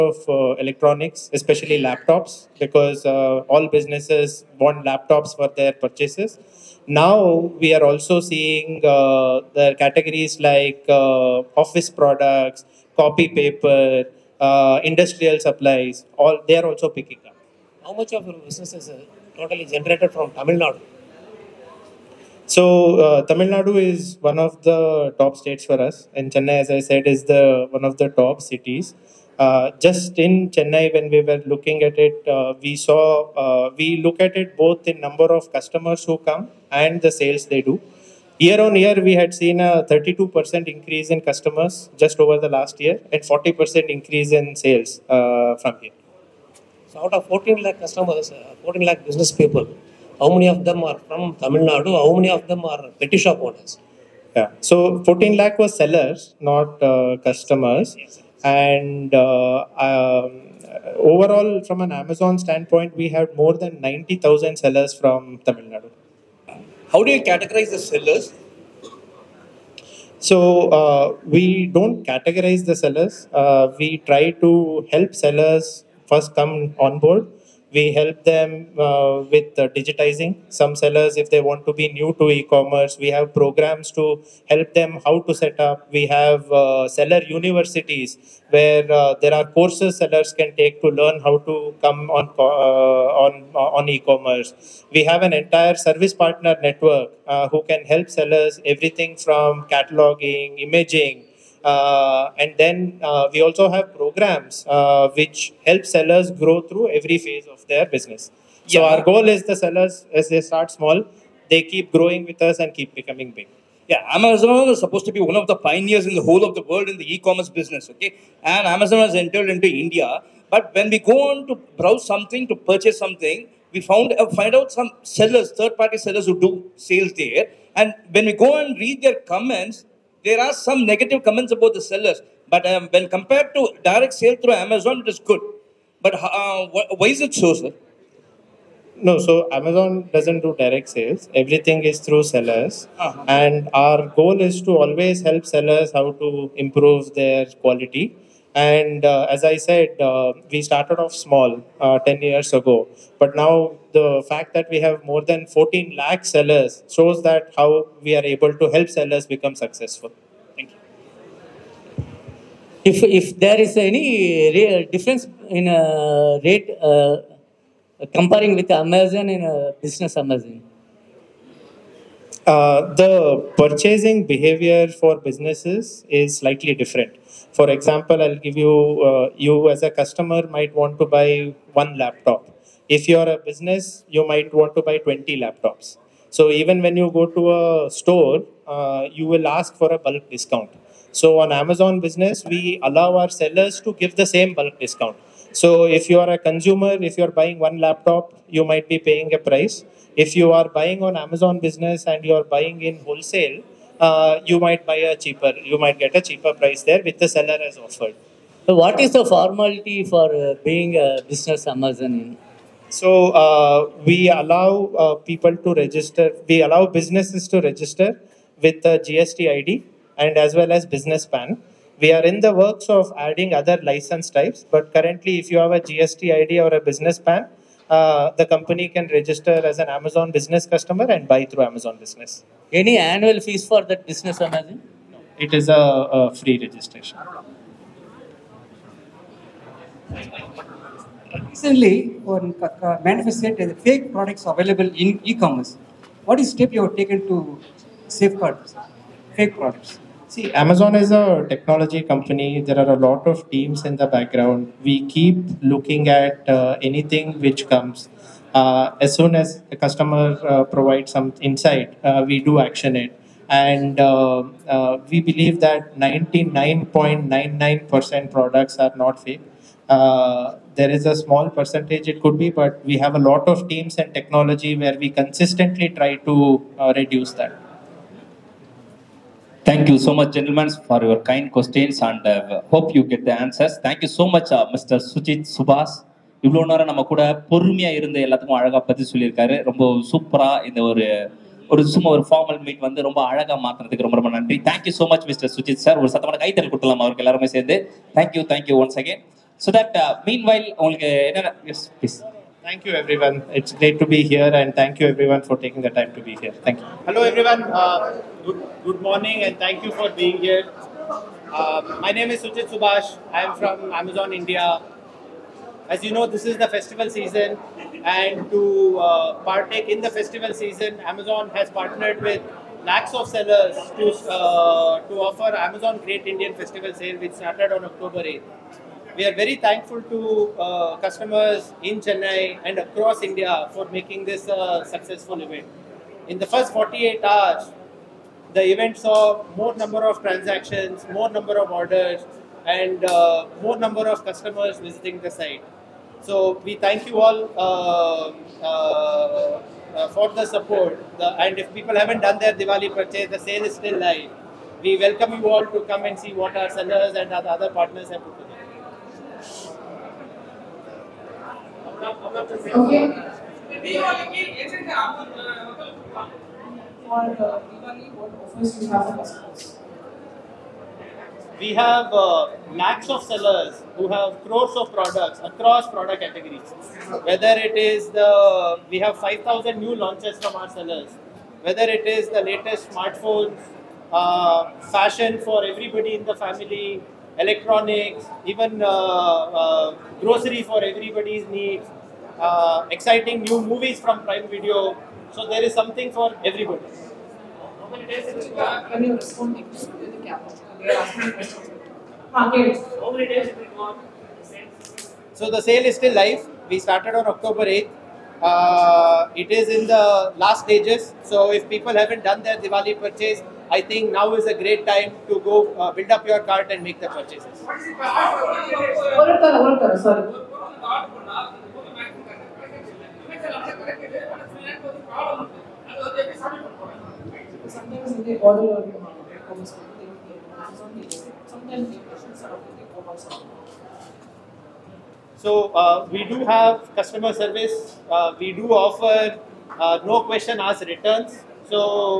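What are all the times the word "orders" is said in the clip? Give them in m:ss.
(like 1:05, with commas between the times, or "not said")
5:41, 7:08.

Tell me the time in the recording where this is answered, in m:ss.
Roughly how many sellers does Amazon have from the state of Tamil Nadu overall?
1:03.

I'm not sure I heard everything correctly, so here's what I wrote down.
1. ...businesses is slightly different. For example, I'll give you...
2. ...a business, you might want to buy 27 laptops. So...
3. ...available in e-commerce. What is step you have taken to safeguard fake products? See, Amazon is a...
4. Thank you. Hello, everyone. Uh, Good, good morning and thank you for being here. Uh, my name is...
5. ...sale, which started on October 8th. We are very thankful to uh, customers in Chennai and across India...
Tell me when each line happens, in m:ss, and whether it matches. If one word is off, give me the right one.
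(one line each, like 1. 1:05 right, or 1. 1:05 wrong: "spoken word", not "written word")
1. 2:55 right
2. 3:03 wrong: "20", not "27"
3. 4:04 right
4. 5:06 right
5. 5:26 right.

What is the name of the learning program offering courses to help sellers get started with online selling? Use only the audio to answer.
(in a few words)
Seller universities.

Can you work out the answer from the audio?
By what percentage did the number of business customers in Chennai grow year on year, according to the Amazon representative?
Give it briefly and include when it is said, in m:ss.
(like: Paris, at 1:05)
32%, at 0:39.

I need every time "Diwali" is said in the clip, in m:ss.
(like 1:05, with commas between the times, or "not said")
5:52, 6:07, 6:52.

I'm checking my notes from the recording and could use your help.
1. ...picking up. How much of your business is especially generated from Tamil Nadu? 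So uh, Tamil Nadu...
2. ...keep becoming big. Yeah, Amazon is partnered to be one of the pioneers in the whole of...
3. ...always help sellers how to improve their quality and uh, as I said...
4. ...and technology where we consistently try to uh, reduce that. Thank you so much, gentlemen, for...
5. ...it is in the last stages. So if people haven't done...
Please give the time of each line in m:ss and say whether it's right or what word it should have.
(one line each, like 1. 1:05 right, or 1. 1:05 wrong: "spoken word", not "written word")
1. 0:16 wrong: "totally", not "especially"
2. 1:52 wrong: "supposed", not "partnered"
3. 2:24 right
4. 4:33 right
5. 6:49 right.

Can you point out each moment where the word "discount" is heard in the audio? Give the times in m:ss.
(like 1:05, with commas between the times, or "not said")
3:10, 3:14.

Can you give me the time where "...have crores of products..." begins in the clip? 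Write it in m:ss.
6:14.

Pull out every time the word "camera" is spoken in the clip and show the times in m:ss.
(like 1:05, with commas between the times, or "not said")
not said.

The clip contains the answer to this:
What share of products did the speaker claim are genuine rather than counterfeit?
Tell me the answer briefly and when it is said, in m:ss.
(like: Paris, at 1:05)
99.99%, at 4:25.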